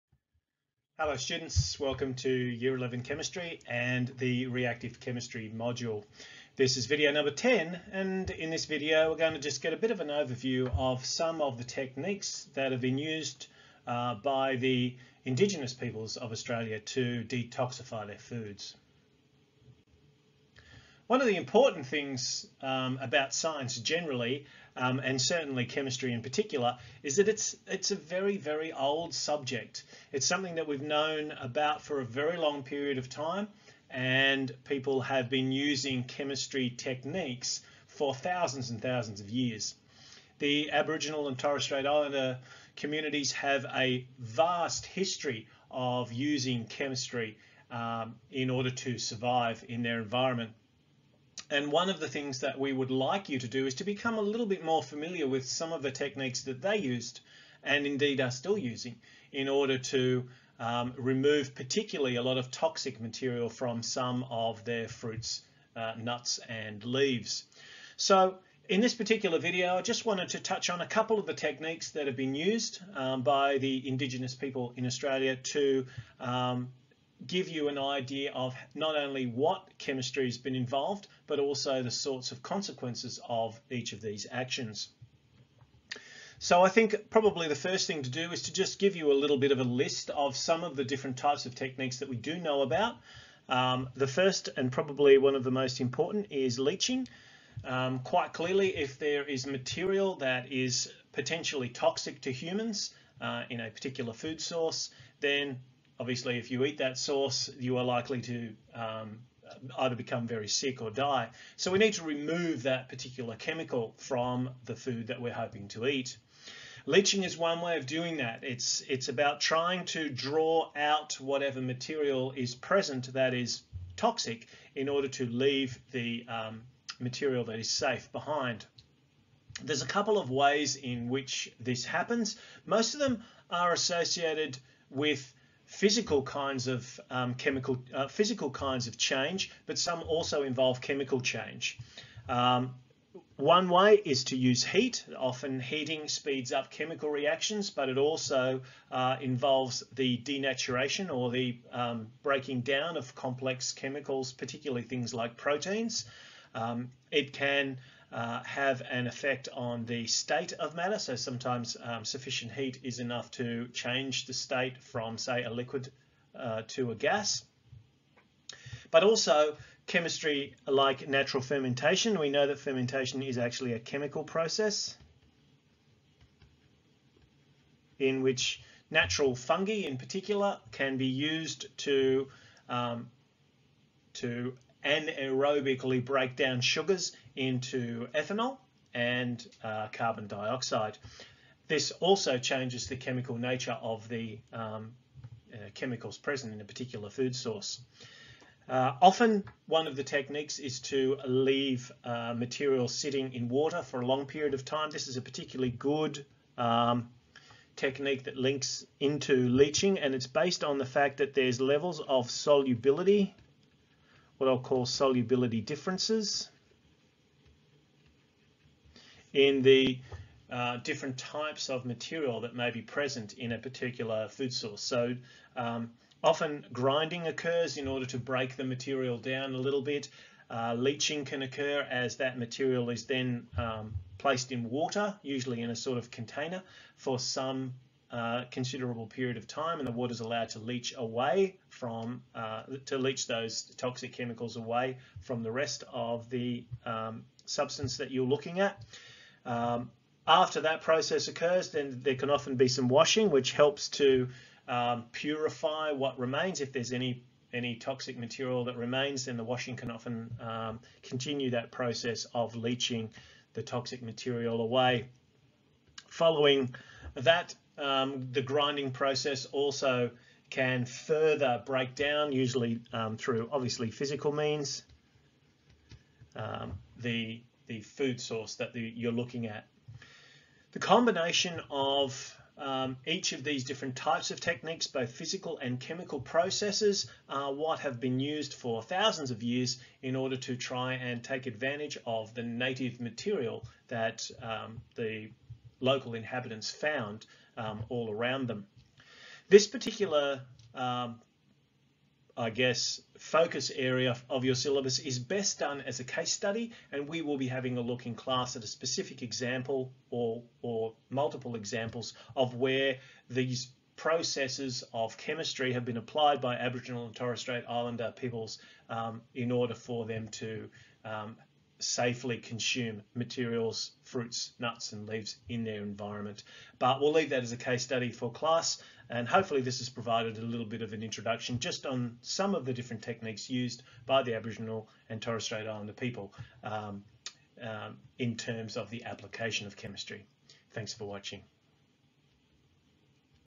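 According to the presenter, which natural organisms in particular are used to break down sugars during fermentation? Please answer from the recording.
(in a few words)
Fungi.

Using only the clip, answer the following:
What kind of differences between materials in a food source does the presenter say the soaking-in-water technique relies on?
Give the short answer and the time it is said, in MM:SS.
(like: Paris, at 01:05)
Solubility differences, at 03:34.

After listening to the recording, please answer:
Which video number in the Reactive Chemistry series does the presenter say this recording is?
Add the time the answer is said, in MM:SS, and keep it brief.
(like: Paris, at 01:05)
10, at 00:06.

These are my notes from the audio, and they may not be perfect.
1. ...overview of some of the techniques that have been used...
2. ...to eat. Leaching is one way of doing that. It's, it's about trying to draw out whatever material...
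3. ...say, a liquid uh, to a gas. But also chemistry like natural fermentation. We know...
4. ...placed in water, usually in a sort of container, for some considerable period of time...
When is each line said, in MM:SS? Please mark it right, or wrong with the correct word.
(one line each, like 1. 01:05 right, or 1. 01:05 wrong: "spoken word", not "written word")
1. 00:10 right
2. 01:55 right
3. 02:45 right
4. 03:54 right.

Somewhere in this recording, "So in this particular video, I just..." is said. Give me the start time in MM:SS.
01:07.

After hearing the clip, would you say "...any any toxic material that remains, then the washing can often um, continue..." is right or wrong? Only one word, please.
right.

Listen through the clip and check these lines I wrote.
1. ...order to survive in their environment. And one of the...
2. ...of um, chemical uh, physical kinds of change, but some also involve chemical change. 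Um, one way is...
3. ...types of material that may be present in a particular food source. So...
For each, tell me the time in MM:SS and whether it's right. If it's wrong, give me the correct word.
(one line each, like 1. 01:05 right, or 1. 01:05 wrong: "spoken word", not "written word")
1. 00:48 right
2. 02:16 right
3. 03:41 right.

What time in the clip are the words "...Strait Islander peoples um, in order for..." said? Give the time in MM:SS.
05:17.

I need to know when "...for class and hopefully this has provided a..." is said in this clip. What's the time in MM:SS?
05:28.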